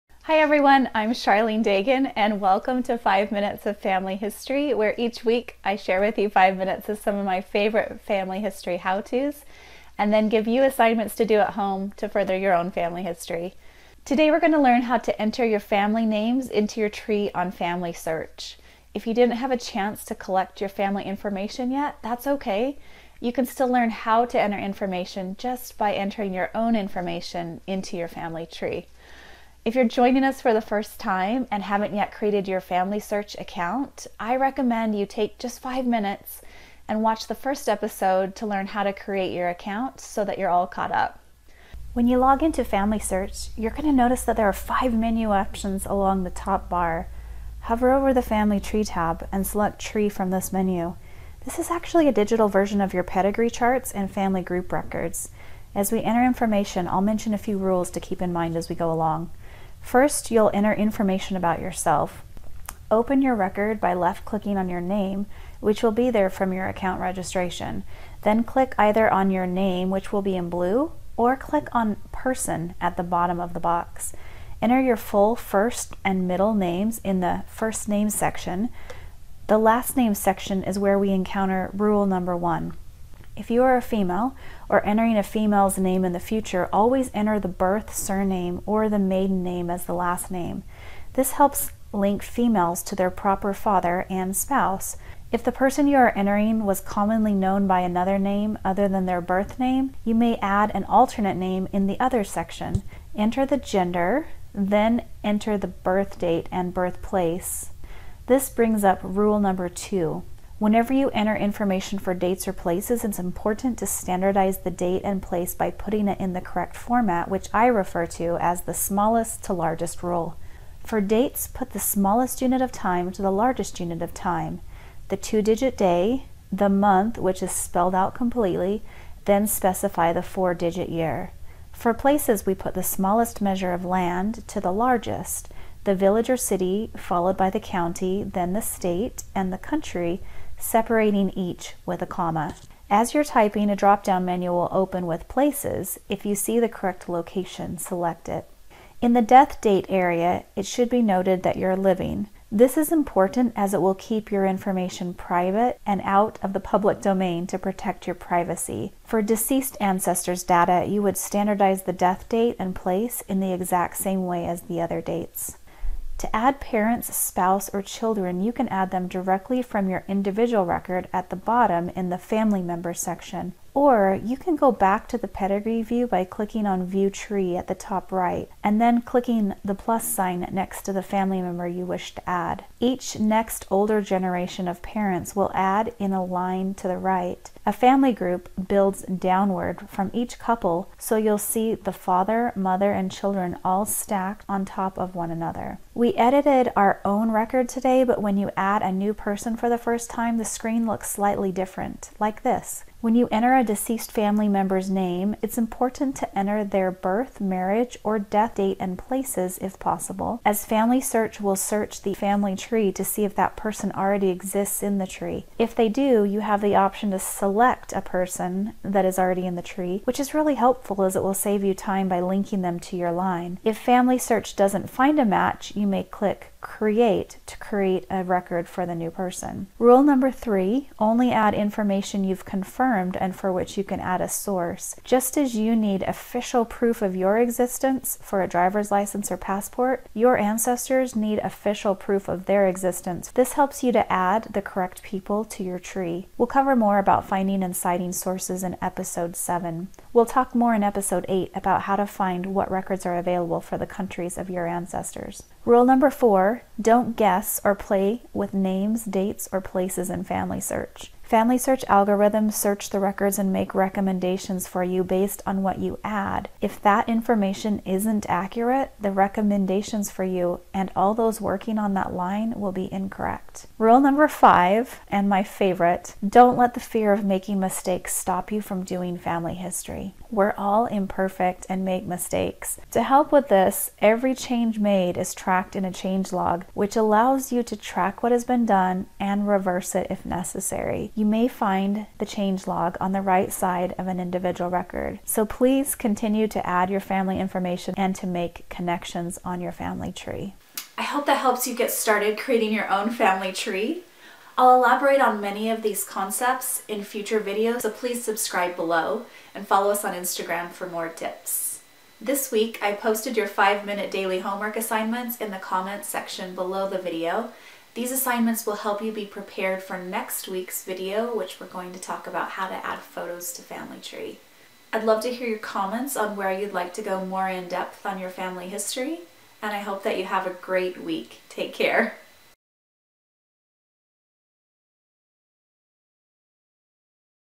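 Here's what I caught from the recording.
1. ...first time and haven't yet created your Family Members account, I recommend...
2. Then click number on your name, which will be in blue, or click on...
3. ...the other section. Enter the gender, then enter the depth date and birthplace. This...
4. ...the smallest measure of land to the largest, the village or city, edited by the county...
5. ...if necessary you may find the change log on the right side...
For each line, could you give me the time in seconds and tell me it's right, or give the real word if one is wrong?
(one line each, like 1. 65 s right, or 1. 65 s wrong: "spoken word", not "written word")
1. 30 s wrong: "Search", not "Members"
2. 68 s wrong: "either", not "number"
3. 101 s wrong: "birth", not "depth"
4. 132 s wrong: "followed", not "edited"
5. 290 s right.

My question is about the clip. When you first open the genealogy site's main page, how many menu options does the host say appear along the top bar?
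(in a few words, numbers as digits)
5.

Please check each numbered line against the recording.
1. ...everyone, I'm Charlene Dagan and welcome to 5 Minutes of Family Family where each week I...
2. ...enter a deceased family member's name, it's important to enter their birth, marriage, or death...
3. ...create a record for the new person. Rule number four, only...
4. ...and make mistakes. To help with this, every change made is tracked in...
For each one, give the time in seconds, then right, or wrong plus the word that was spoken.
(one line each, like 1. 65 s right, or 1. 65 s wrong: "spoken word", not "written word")
1. 0 s wrong: "History", not "Family"
2. 203 s right
3. 227 s wrong: "three", not "four"
4. 281 s right.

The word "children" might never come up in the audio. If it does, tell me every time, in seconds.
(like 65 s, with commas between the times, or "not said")
167 s, 193 s.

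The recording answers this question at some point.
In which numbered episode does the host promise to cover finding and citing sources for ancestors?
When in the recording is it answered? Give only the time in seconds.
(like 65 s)
248 s.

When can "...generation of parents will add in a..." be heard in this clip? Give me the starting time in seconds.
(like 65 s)
184 s.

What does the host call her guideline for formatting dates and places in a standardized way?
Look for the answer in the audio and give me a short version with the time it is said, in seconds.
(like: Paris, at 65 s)
smallest to largest rule, at 118 s.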